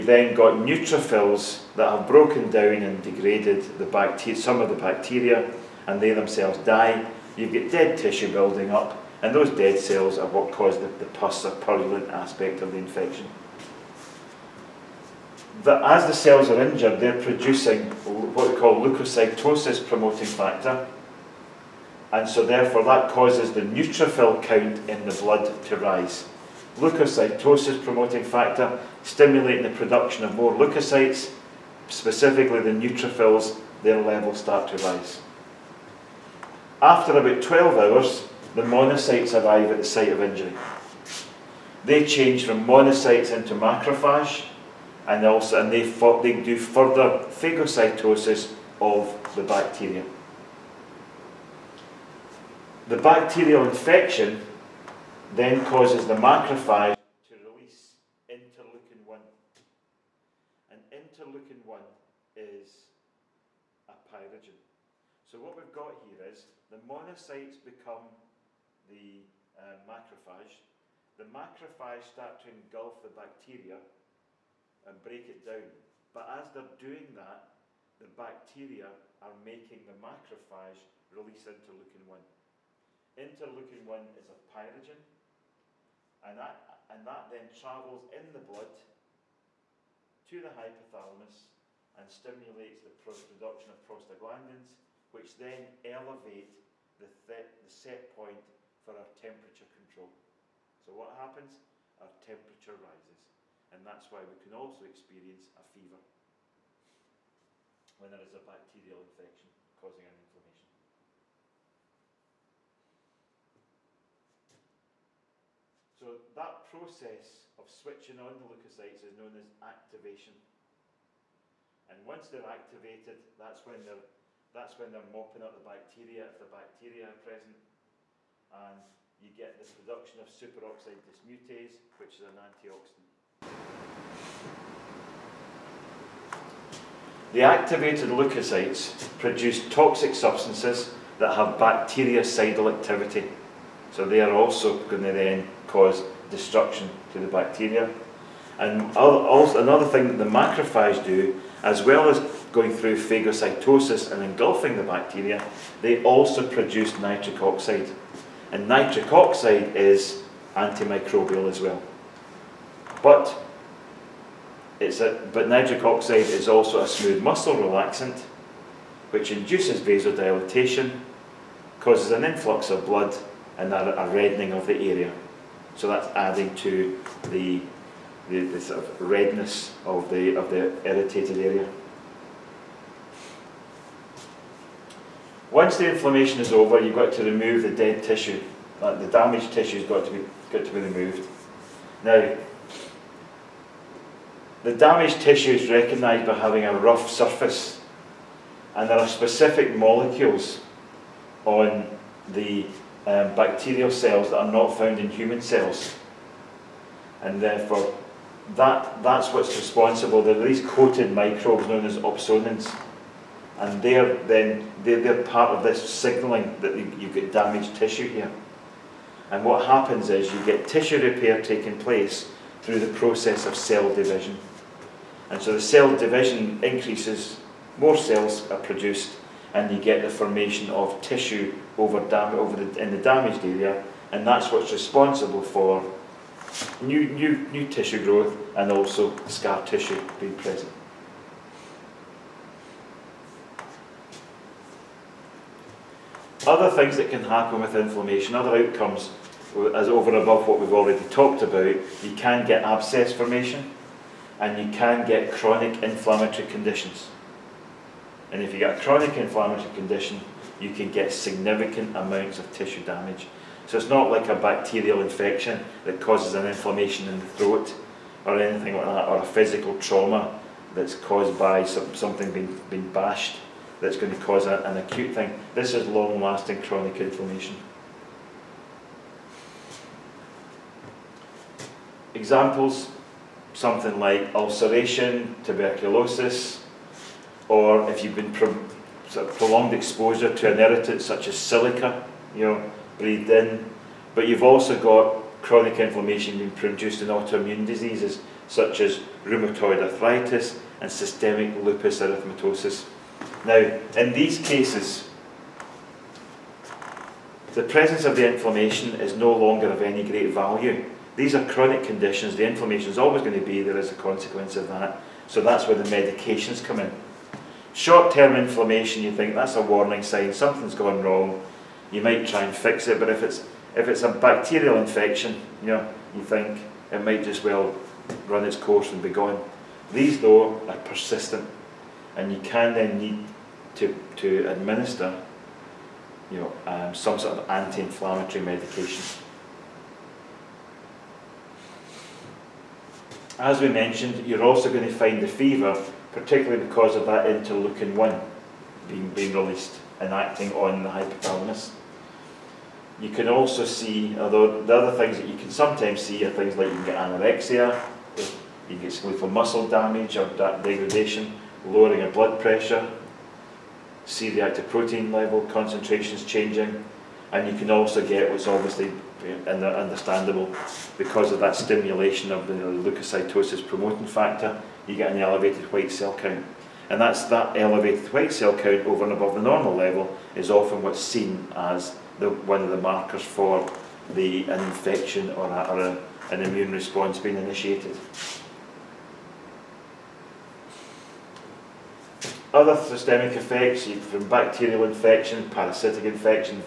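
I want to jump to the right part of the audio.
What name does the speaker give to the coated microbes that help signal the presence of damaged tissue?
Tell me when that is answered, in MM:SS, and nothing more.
03:31.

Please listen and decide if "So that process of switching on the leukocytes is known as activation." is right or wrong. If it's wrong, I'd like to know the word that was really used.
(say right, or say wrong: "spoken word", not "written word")
right.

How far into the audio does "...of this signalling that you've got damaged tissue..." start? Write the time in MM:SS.
03:35.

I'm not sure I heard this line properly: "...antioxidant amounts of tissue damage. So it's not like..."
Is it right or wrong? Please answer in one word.
wrong.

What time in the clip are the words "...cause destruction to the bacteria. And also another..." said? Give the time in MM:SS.
02:25.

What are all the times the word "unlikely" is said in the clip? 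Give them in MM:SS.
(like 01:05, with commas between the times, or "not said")
not said.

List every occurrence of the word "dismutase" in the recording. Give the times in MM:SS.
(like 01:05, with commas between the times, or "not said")
02:11.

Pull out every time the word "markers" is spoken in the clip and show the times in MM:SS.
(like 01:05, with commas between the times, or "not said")
06:22.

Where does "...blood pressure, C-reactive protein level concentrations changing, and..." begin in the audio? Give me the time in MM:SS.
06:02.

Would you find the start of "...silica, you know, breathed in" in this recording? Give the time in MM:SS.
04:51.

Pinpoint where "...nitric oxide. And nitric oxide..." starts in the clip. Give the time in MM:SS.
02:36.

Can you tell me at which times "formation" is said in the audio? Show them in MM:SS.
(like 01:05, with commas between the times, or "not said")
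03:50, 04:13.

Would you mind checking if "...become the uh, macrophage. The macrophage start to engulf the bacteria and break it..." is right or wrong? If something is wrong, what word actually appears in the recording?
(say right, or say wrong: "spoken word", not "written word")
right.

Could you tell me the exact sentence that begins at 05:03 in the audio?
Now, in these cases, the presence of the inflammation is no longer of any great value.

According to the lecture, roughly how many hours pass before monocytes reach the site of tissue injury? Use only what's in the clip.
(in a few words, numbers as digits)
12.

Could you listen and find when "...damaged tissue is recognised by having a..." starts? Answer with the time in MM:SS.
03:14.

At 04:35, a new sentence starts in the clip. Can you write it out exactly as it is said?
This is long lasting chronic inflammation.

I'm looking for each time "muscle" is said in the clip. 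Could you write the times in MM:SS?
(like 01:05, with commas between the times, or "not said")
02:47, 05:59.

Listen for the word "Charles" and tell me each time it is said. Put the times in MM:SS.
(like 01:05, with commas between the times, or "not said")
not said.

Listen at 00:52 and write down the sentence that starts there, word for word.
The bacterial infection then causes the macrophage to release interleukin 1.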